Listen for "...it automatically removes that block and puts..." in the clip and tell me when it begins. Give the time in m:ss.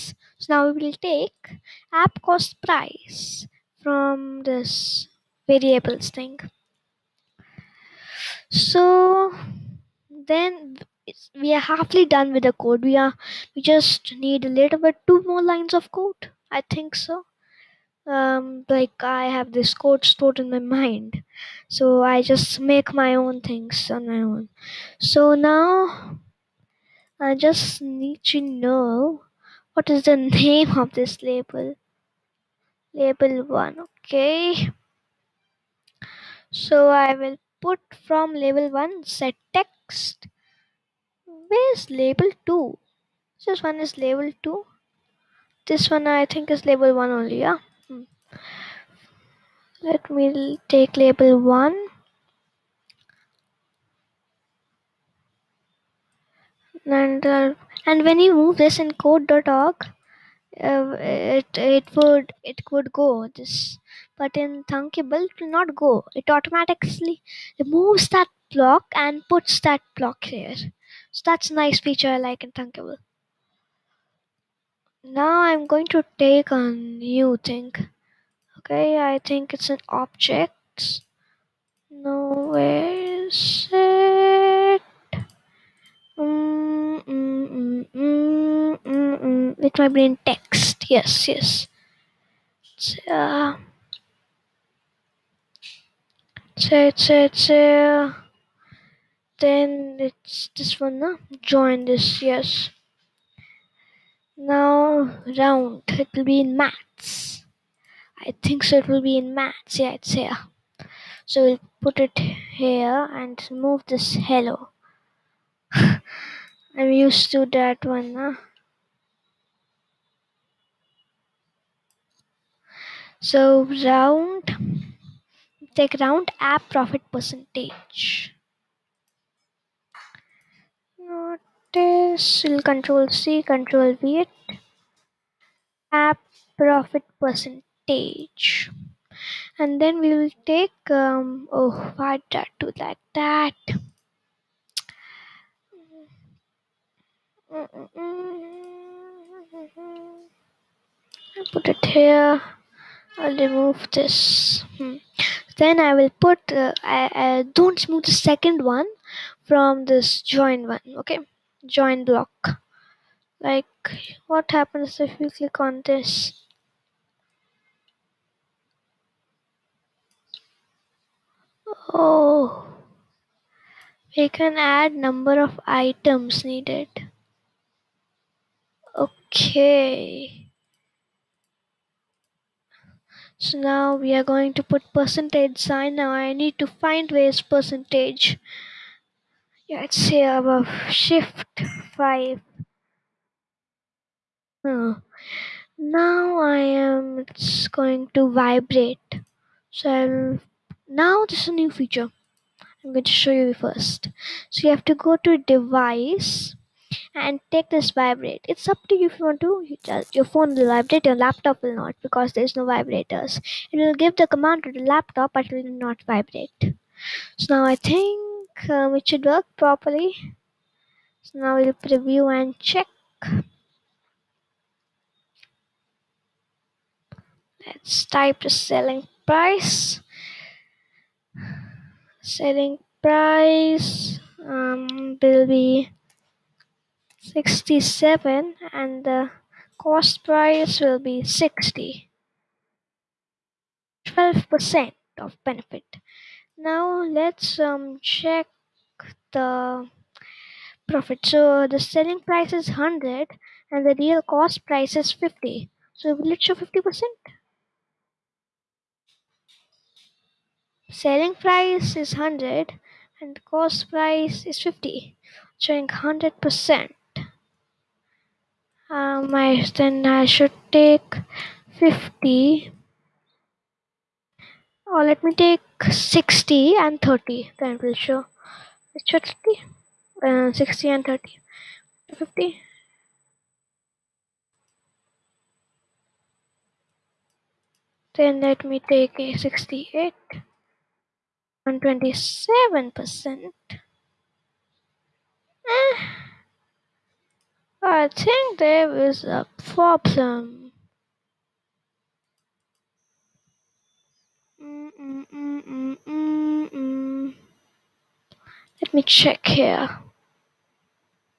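1:06.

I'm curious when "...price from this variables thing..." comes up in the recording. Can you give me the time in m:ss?
0:02.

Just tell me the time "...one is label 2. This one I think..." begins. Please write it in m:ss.
0:43.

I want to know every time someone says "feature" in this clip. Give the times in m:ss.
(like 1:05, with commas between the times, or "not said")
1:11, 3:21.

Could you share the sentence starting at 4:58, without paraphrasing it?
I think there is a problem.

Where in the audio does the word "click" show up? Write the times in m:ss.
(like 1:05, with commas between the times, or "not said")
2:45.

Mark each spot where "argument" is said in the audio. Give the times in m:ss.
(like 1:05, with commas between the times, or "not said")
not said.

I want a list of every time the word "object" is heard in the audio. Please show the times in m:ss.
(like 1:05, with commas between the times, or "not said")
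1:19.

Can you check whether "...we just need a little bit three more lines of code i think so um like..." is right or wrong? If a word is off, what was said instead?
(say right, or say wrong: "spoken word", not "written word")
wrong: "two", not "three".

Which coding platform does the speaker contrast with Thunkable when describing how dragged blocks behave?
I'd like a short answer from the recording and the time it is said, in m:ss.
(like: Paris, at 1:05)
code.org, at 0:58.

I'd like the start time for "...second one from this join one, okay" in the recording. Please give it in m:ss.
2:38.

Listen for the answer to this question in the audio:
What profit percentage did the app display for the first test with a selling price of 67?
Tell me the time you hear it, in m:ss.
4:04.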